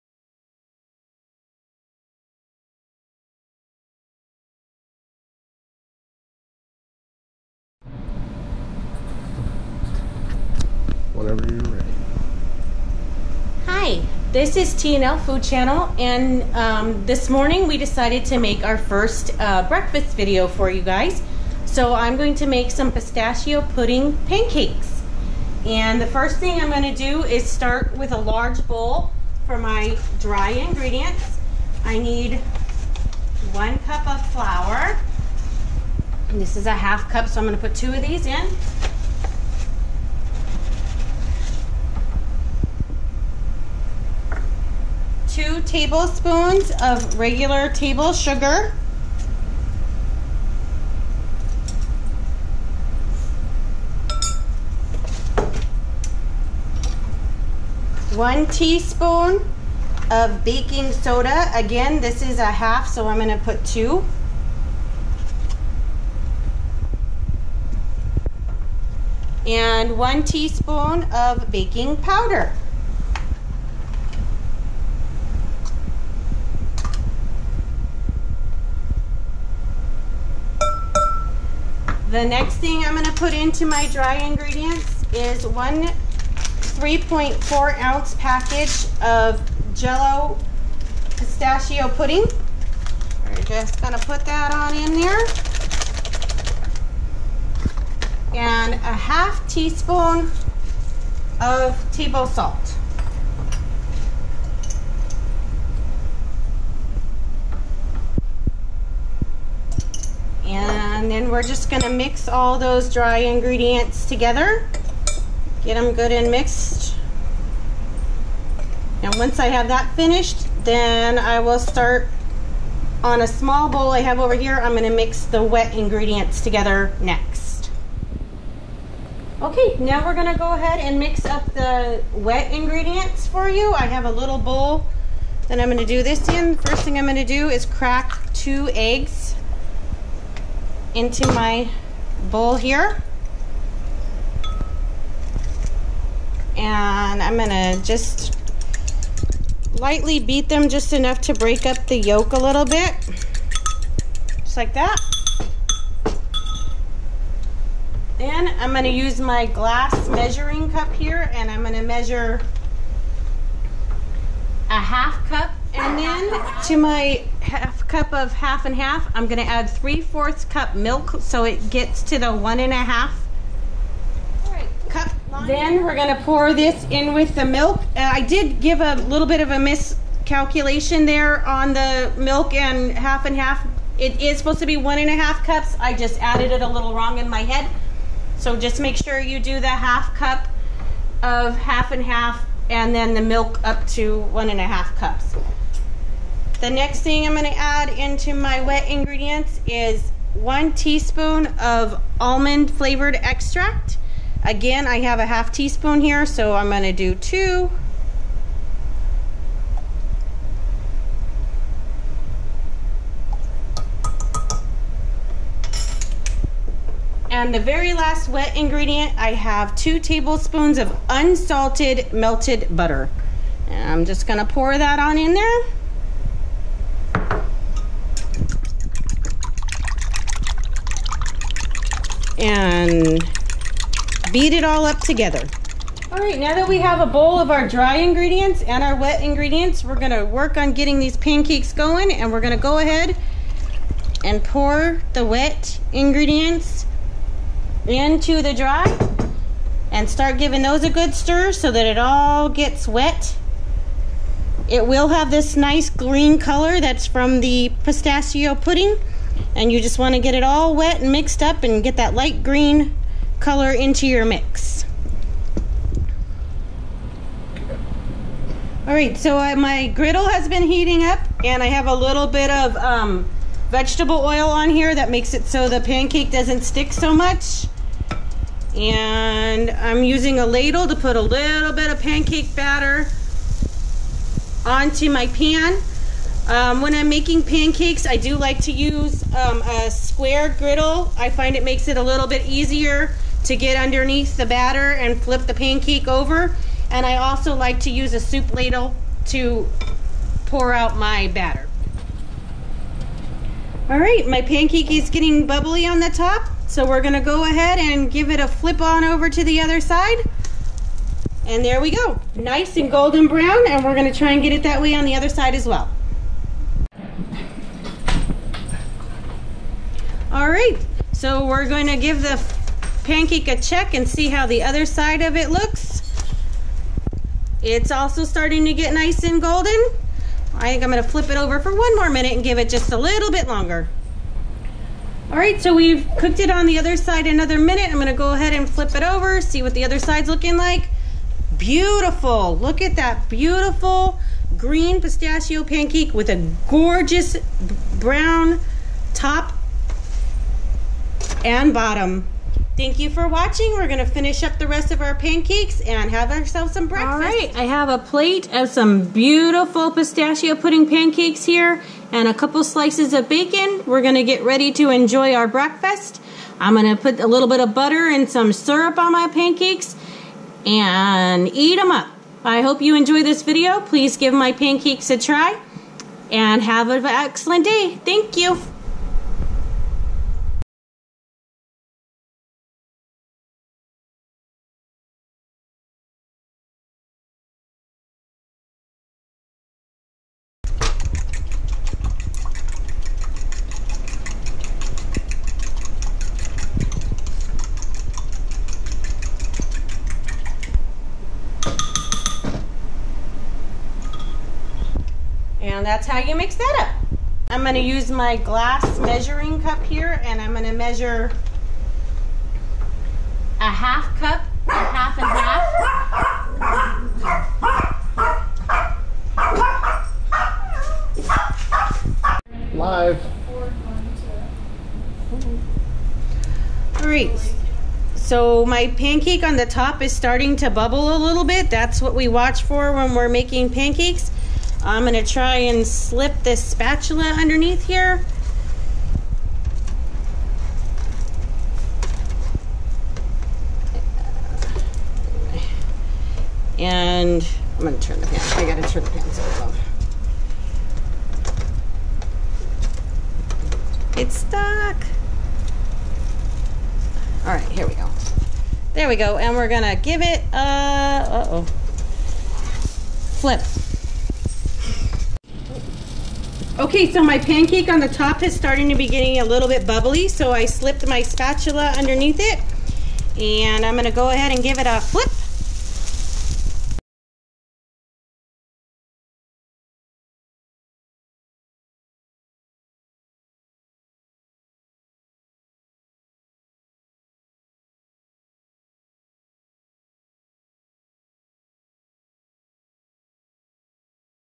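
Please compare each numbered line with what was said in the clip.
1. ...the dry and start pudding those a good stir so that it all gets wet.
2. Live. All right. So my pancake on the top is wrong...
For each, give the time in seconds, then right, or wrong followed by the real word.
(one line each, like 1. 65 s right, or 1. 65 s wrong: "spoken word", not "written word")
1. 248 s wrong: "giving", not "pudding"
2. 422 s wrong: "starting", not "wrong".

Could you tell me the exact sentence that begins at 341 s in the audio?
Beautiful, look at that beautiful green pistachio pancake with a gorgeous brown top and bottom.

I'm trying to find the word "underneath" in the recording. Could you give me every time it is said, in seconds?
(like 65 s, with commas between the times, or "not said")
293 s, 437 s, 471 s.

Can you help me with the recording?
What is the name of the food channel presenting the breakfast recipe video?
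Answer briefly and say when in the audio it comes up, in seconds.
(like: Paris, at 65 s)
TNL Food Channel, at 14 s.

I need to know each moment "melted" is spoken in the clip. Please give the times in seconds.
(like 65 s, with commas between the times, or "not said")
222 s.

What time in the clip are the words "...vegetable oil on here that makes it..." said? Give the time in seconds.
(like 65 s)
273 s.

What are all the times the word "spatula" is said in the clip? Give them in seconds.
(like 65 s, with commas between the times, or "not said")
436 s, 471 s.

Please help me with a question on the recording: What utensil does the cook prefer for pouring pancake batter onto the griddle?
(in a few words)
Soup ladle.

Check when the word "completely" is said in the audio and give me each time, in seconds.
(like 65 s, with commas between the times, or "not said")
not said.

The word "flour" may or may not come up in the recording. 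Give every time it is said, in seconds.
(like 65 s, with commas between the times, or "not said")
34 s.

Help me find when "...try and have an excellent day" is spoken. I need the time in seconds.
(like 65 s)
375 s.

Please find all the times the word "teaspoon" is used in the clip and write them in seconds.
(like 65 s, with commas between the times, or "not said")
58 s, 70 s, 99 s, 200 s, 205 s.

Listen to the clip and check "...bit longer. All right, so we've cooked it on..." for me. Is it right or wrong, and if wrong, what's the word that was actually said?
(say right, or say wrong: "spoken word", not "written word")
right.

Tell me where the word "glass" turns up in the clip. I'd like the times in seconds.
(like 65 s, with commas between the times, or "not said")
159 s, 408 s.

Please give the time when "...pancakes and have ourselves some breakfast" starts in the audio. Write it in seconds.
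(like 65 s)
355 s.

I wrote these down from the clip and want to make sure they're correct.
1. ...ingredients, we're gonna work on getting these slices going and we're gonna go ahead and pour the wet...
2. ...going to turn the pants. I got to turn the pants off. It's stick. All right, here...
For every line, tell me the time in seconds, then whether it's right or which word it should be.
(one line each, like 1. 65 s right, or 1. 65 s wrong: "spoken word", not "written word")
1. 239 s wrong: "pancakes", not "slices"
2. 447 s wrong: "stuck", not "stick".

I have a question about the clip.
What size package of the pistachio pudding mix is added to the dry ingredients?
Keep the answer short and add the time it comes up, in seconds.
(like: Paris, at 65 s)
3.4 ounce, at 85 s.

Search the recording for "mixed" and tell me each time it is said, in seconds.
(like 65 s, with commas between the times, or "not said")
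116 s, 261 s.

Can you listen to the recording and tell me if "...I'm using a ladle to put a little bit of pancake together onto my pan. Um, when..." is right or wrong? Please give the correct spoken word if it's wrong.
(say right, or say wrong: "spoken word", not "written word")
wrong: "batter", not "together".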